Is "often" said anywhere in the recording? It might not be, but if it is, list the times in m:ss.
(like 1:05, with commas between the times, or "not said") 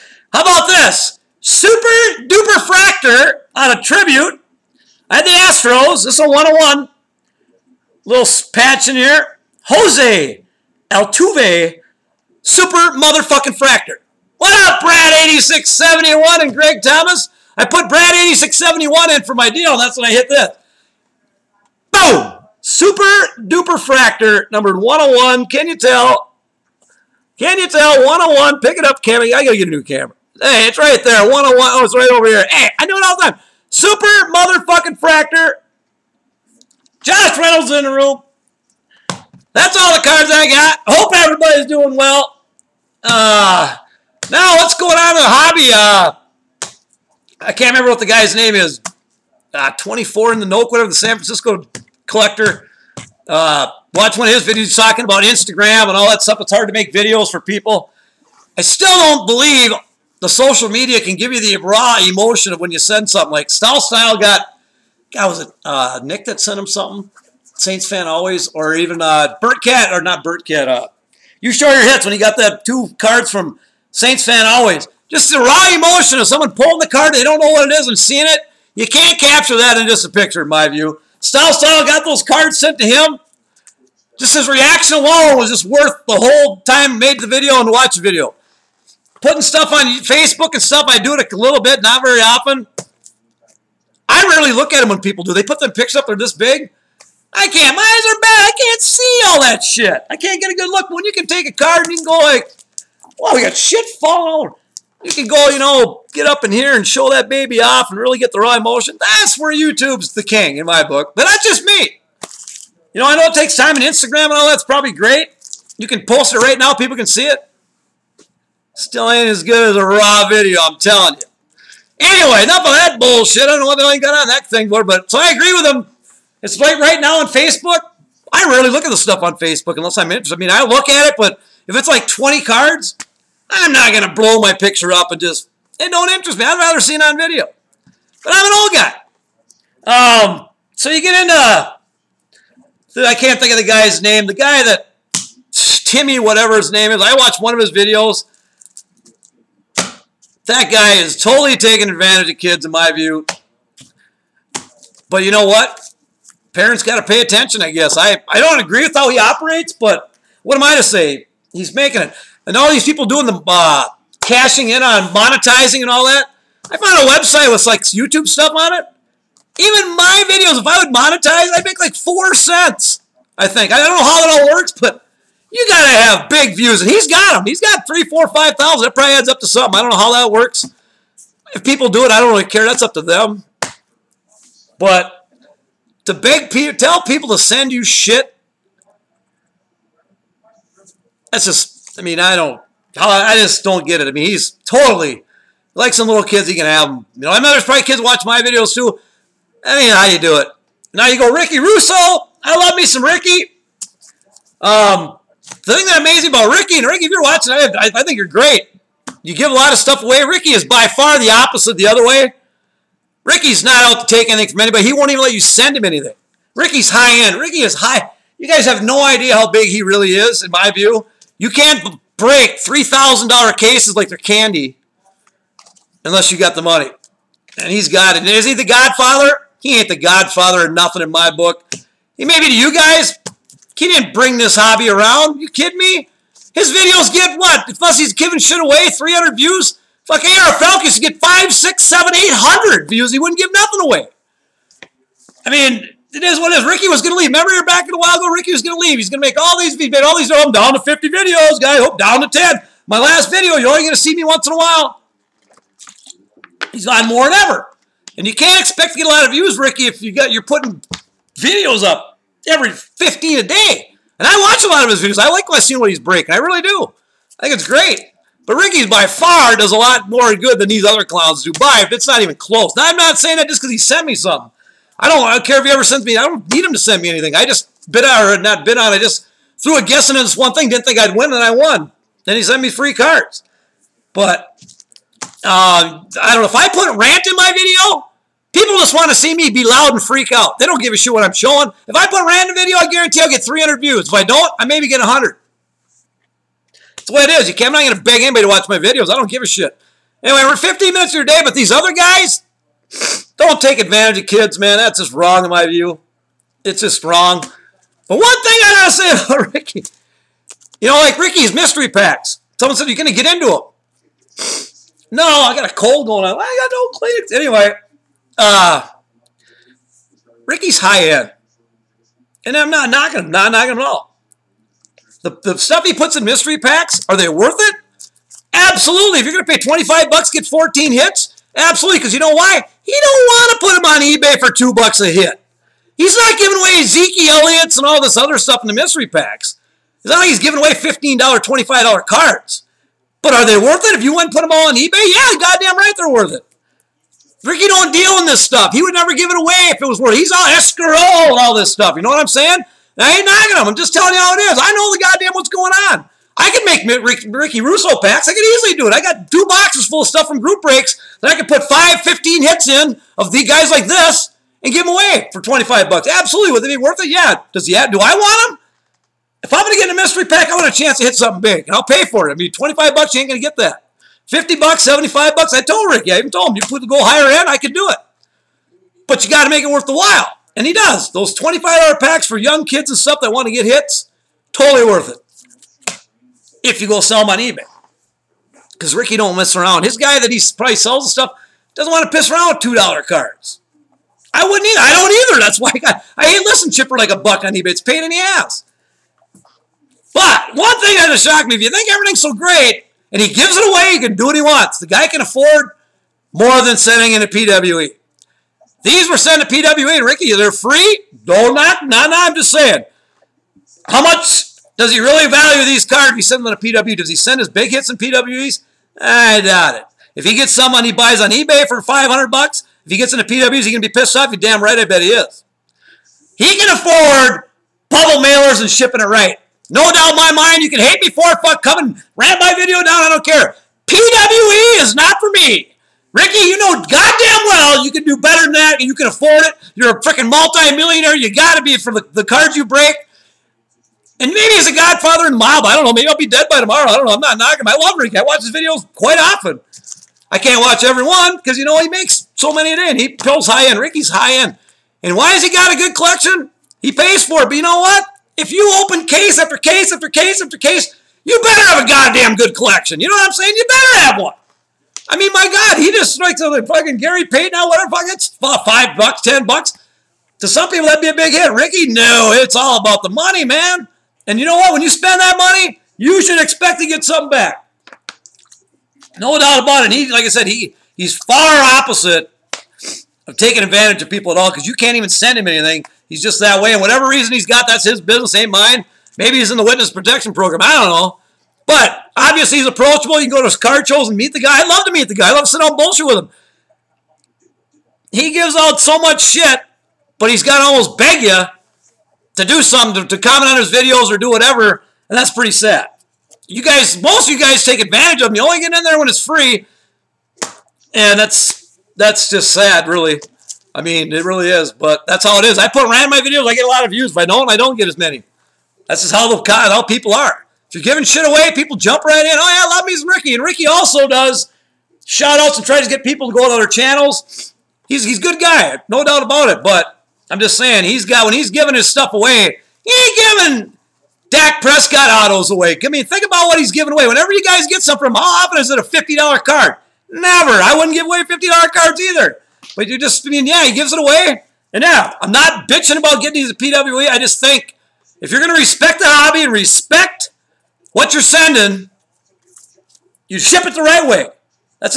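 1:32, 7:29, 8:58.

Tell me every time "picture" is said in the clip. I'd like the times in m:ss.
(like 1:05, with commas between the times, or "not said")
1:20, 1:35, 2:14.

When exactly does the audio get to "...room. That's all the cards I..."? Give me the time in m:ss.
0:37.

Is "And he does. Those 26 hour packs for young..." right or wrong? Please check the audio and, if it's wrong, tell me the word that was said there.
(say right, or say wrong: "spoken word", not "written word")
wrong: "25", not "26".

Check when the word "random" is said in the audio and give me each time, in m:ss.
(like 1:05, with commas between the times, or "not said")
4:52, 8:35.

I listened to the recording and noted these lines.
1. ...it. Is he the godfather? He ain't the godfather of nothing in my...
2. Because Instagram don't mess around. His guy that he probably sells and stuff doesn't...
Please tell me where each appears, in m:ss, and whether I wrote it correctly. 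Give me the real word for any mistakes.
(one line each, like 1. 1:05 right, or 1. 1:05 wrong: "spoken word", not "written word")
1. 3:48 right
2. 6:28 wrong: "Ricky", not "Instagram".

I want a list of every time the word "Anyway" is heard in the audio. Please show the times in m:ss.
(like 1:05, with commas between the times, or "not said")
2:01, 5:00, 5:17.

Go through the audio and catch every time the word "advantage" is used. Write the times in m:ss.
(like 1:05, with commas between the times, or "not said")
2:31, 5:03, 8:03, 8:27.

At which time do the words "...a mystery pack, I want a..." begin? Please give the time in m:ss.
6:09.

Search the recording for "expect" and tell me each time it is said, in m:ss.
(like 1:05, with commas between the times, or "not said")
4:18, 7:56.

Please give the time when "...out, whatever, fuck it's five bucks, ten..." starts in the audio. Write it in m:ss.
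7:47.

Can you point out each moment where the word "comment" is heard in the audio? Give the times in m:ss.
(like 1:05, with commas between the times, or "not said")
8:23.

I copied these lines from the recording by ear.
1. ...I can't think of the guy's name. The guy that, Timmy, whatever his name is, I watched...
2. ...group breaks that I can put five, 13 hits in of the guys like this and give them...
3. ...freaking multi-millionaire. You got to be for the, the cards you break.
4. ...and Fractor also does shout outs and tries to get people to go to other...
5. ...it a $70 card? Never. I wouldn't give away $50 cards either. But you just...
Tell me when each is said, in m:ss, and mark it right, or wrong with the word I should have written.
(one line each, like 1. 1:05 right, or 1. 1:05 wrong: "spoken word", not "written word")
1. 2:23 right
2. 6:00 wrong: "15", not "13"
3. 7:20 right
4. 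8:43 wrong: "Ricky", not "Fractor"
5. 8:58 wrong: "50", not "70".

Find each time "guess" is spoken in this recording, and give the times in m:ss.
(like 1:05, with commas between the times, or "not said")
2:37, 4:39.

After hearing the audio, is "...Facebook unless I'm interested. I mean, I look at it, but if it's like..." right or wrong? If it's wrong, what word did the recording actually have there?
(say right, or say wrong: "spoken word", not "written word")
right.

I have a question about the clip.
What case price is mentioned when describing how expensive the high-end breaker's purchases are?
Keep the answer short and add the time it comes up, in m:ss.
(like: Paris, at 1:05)
$3,000, at 3:42.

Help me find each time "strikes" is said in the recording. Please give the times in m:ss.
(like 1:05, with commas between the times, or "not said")
7:46.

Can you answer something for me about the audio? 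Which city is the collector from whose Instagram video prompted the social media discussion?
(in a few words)
San Francisco.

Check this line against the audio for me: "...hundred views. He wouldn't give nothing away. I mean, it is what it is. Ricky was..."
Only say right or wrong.
right.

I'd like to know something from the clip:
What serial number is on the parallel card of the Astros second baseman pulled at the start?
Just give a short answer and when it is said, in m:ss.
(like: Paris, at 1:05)
101, at 0:06.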